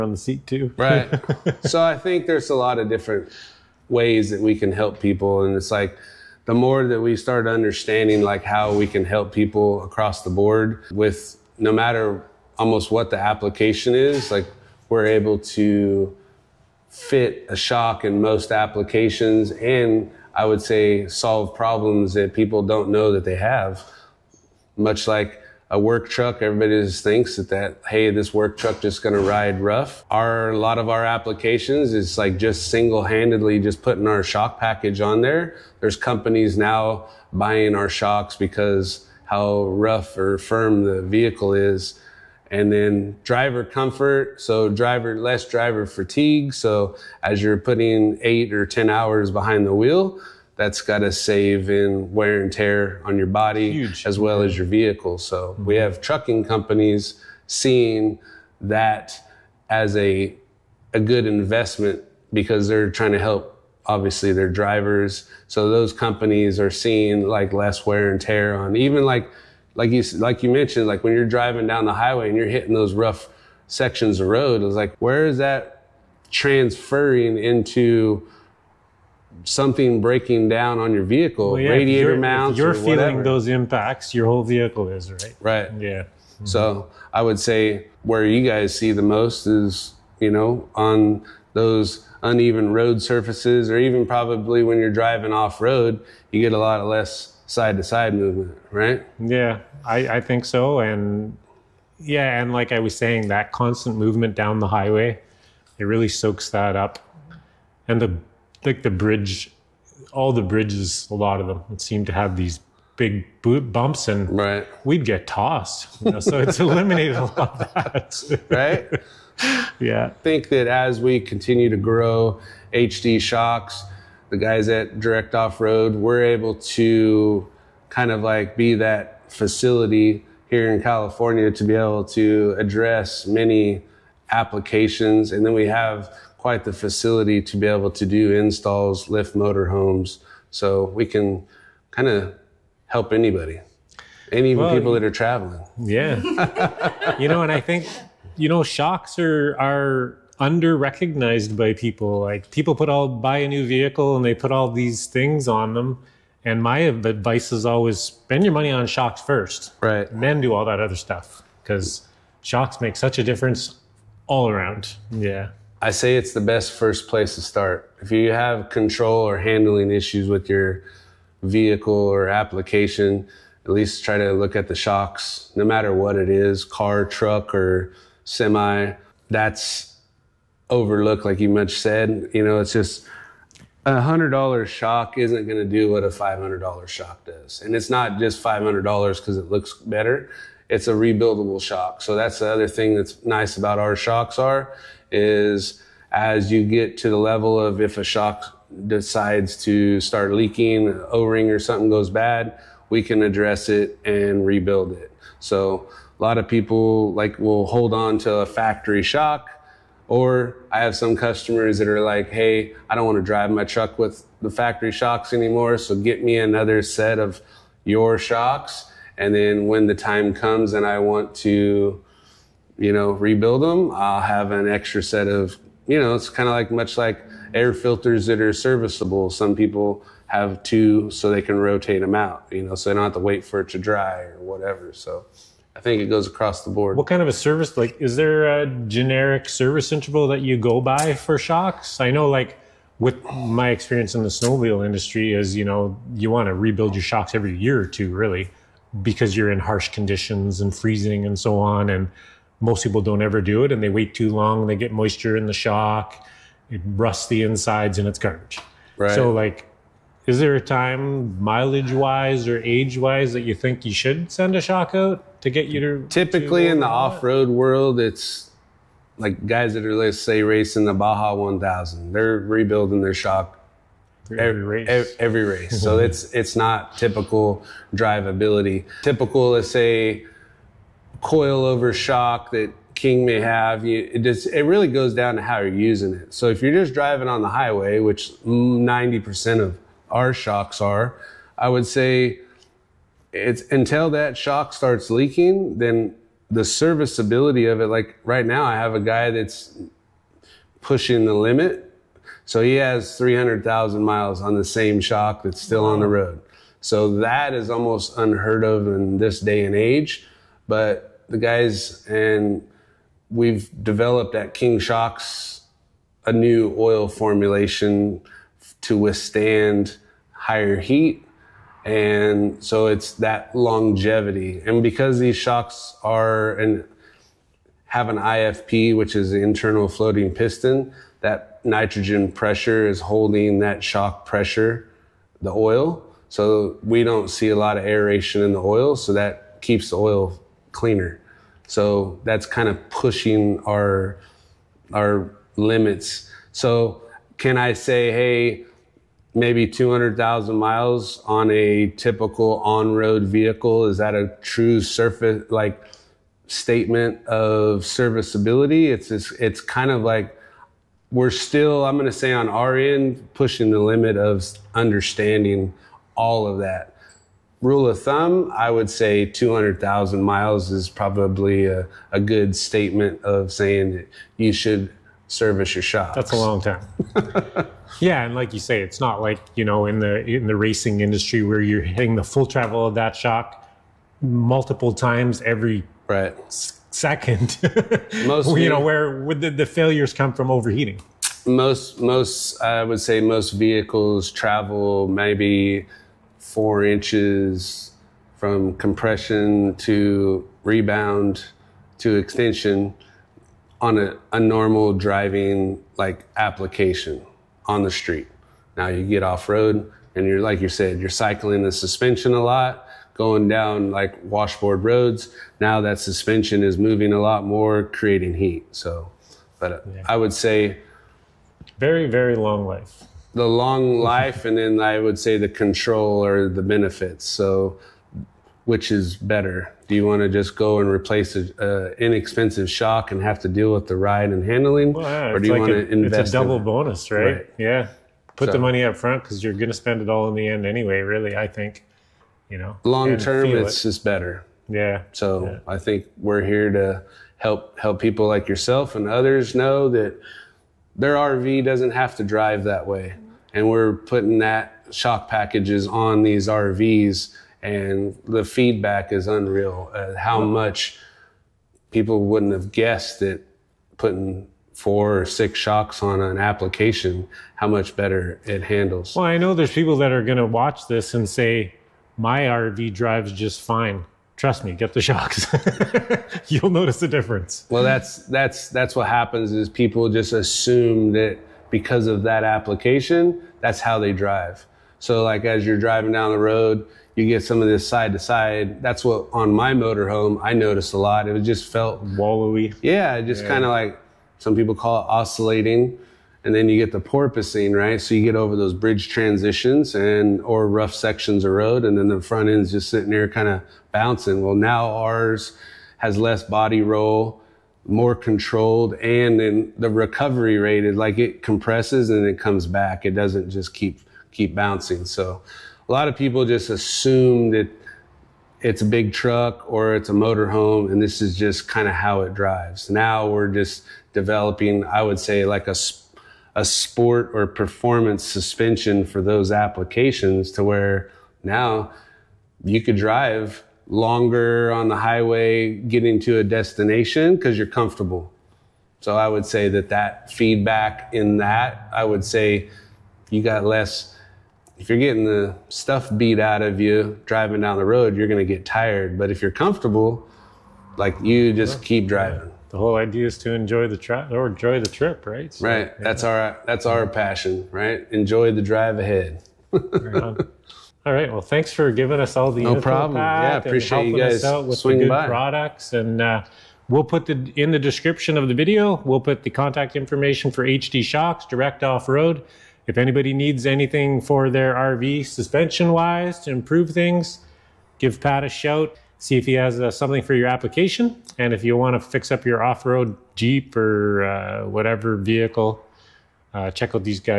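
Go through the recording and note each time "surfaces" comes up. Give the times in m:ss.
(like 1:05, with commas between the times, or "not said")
1:33, 5:54.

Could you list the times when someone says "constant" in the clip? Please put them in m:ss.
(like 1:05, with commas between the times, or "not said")
1:43.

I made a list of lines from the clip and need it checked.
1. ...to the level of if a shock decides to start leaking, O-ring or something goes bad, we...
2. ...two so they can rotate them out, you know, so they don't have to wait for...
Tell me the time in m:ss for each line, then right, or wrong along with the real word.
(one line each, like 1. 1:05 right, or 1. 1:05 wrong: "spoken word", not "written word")
1. 3:16 right
2. 3:50 right.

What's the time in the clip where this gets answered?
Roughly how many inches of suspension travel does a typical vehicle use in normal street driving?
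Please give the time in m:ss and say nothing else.
6:36.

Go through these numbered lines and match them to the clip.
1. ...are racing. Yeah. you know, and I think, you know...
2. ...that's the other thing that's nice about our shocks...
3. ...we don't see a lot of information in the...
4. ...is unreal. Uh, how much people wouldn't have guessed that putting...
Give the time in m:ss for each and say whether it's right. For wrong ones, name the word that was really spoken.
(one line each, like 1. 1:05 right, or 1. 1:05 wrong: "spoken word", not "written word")
1. 2:25 wrong: "traveling", not "racing"
2. 3:12 right
3. 5:36 wrong: "aeration", not "information"
4. 7:39 right.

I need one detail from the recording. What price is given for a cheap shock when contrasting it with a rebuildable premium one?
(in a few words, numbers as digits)
$100.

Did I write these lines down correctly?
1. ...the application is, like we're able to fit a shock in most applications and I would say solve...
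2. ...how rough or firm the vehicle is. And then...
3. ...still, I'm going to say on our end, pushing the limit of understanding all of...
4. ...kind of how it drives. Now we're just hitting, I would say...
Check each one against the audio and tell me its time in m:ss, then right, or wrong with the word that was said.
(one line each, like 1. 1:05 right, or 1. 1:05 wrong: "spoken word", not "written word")
1. 0:13 right
2. 0:39 right
3. 6:01 right
4. 8:41 wrong: "developing", not "hitting".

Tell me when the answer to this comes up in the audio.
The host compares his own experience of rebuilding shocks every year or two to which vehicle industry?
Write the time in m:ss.
4:04.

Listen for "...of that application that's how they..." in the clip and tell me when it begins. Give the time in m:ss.
8:02.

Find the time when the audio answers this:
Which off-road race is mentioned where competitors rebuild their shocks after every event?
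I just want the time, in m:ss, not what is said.
4:30.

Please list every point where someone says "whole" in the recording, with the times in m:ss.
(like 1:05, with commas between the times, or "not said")
1:24, 9:12.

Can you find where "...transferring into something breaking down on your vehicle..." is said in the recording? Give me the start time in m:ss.
1:16.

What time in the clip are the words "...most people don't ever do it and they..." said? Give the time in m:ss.
4:12.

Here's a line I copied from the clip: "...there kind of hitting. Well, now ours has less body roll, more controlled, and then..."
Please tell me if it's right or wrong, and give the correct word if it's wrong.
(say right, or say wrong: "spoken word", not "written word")
wrong: "bouncing", not "hitting".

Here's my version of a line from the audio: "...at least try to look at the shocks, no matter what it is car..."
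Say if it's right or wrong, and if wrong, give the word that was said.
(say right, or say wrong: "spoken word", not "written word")
right.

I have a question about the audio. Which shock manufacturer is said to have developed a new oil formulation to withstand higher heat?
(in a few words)
King Shocks.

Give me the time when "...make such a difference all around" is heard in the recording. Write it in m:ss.
2:42.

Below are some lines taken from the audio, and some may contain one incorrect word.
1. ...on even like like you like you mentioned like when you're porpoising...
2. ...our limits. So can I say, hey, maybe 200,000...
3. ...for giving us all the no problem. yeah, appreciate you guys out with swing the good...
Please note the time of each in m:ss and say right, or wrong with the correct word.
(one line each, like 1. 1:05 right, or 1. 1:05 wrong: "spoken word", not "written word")
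1. 1:08 wrong: "driving", not "porpoising"
2. 5:44 right
3. 9:21 right.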